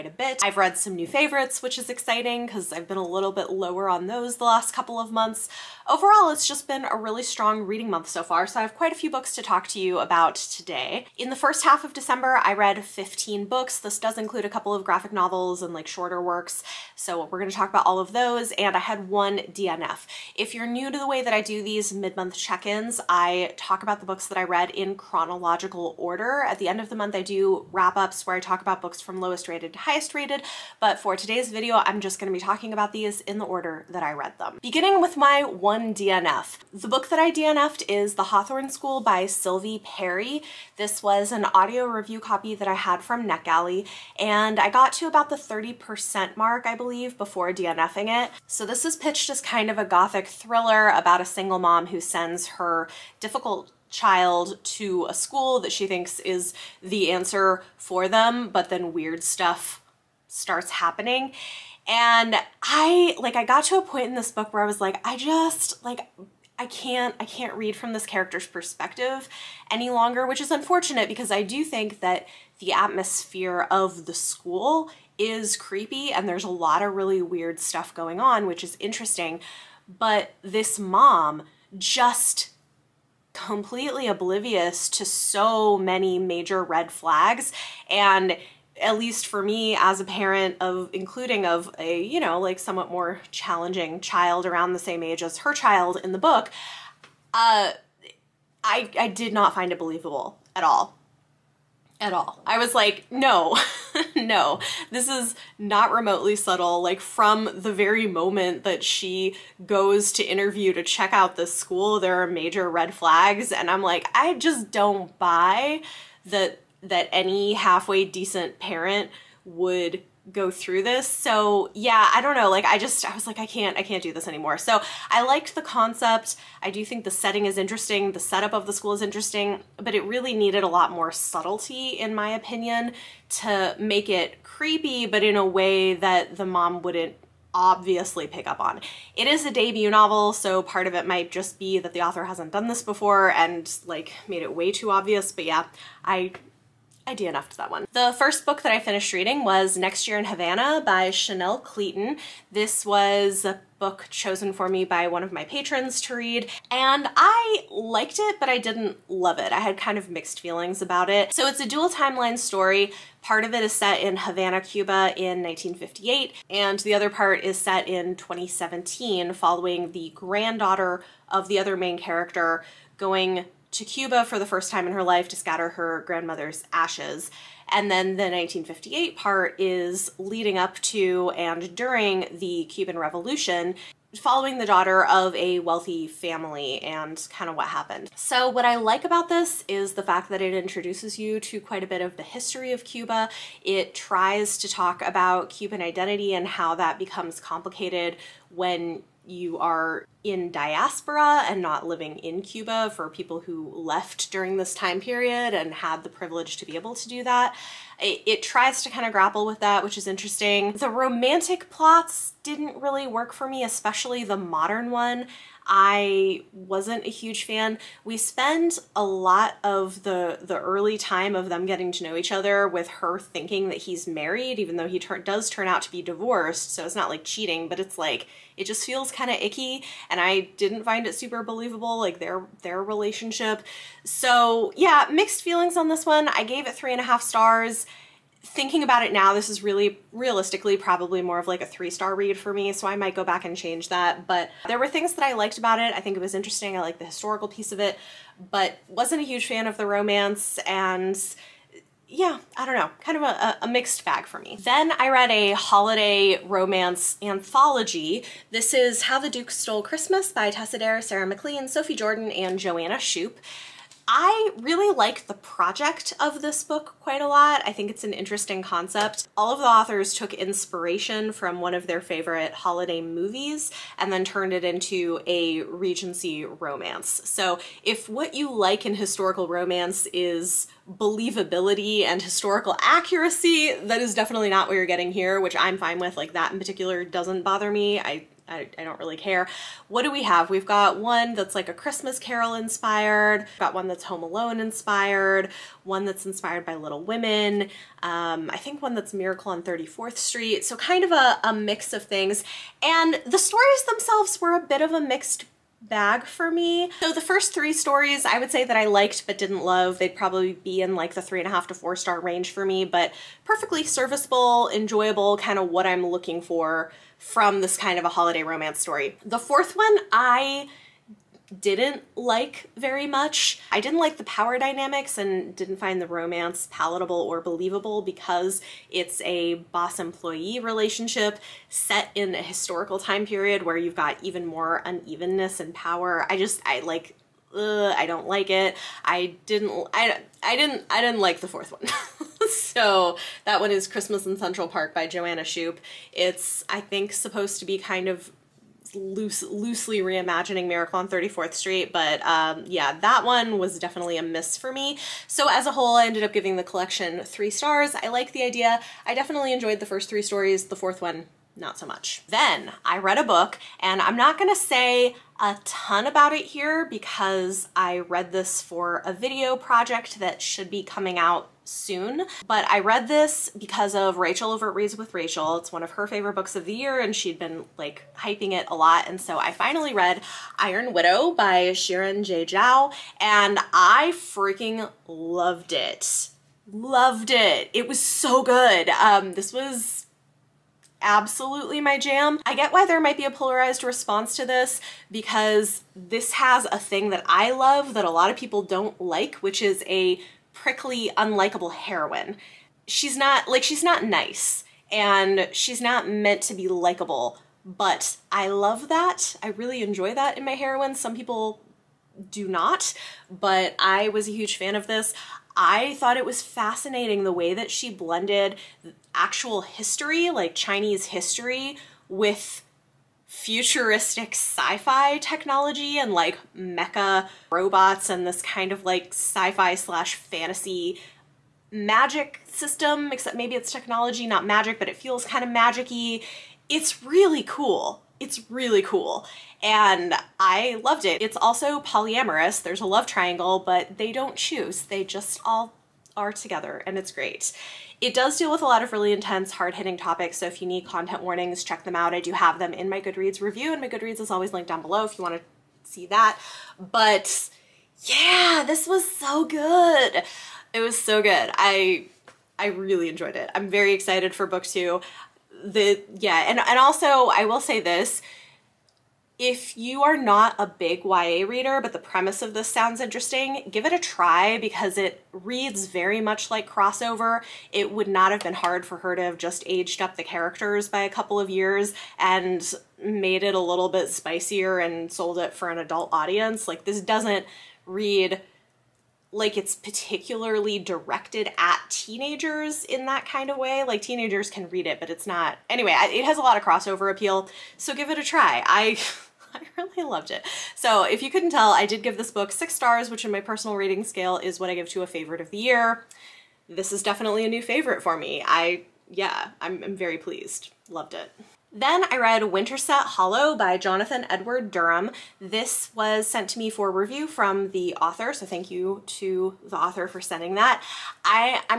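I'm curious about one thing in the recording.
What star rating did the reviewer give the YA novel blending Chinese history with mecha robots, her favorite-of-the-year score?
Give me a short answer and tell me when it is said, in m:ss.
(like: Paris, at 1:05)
6 stars, at 8:22.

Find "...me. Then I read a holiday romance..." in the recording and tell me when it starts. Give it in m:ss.
4:14.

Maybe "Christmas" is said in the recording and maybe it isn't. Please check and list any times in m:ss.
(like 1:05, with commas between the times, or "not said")
4:19, 4:51, 5:43.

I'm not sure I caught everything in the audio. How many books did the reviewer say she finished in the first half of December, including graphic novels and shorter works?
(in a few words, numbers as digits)
15.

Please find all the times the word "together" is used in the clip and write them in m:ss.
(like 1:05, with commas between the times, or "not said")
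7:26.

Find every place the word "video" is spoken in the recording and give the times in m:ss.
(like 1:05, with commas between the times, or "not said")
0:31, 6:09.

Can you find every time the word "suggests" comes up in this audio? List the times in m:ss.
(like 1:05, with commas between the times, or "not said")
not said.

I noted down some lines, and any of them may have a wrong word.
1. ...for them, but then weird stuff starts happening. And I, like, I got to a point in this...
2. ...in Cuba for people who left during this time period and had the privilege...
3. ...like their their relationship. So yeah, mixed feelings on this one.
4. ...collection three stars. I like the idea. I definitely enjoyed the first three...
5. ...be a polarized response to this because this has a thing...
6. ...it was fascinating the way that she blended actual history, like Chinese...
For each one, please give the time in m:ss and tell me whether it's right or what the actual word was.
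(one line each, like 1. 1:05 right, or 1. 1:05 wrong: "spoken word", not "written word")
1. 0:57 right
2. 3:22 right
3. 3:51 right
4. 5:56 right
5. 6:33 right
6. 6:56 right.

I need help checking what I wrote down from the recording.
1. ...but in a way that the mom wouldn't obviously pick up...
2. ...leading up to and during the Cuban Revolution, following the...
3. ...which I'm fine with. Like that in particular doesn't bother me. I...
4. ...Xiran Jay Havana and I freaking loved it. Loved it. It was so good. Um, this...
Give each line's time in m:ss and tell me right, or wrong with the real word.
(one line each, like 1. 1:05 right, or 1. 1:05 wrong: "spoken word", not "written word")
1. 2:15 right
2. 3:00 right
3. 4:45 right
4. 6:21 wrong: "Zhao", not "Havana".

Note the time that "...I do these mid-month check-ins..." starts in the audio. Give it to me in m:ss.
0:21.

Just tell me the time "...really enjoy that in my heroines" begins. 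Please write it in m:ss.
6:49.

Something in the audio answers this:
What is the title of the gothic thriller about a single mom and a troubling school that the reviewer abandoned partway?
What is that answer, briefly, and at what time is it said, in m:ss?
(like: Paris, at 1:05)
The Hawthorne School, at 0:38.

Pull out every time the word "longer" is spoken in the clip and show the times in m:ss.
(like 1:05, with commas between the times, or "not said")
1:09.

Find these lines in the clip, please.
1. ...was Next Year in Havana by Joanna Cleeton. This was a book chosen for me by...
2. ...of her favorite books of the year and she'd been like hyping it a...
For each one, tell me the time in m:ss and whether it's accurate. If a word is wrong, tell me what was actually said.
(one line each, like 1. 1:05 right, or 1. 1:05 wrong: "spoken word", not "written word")
1. 2:29 wrong: "Chanel", not "Joanna"
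2. 6:15 right.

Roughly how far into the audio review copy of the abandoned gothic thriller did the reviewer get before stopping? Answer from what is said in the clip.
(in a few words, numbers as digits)
30%.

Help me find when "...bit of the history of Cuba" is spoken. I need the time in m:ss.
3:11.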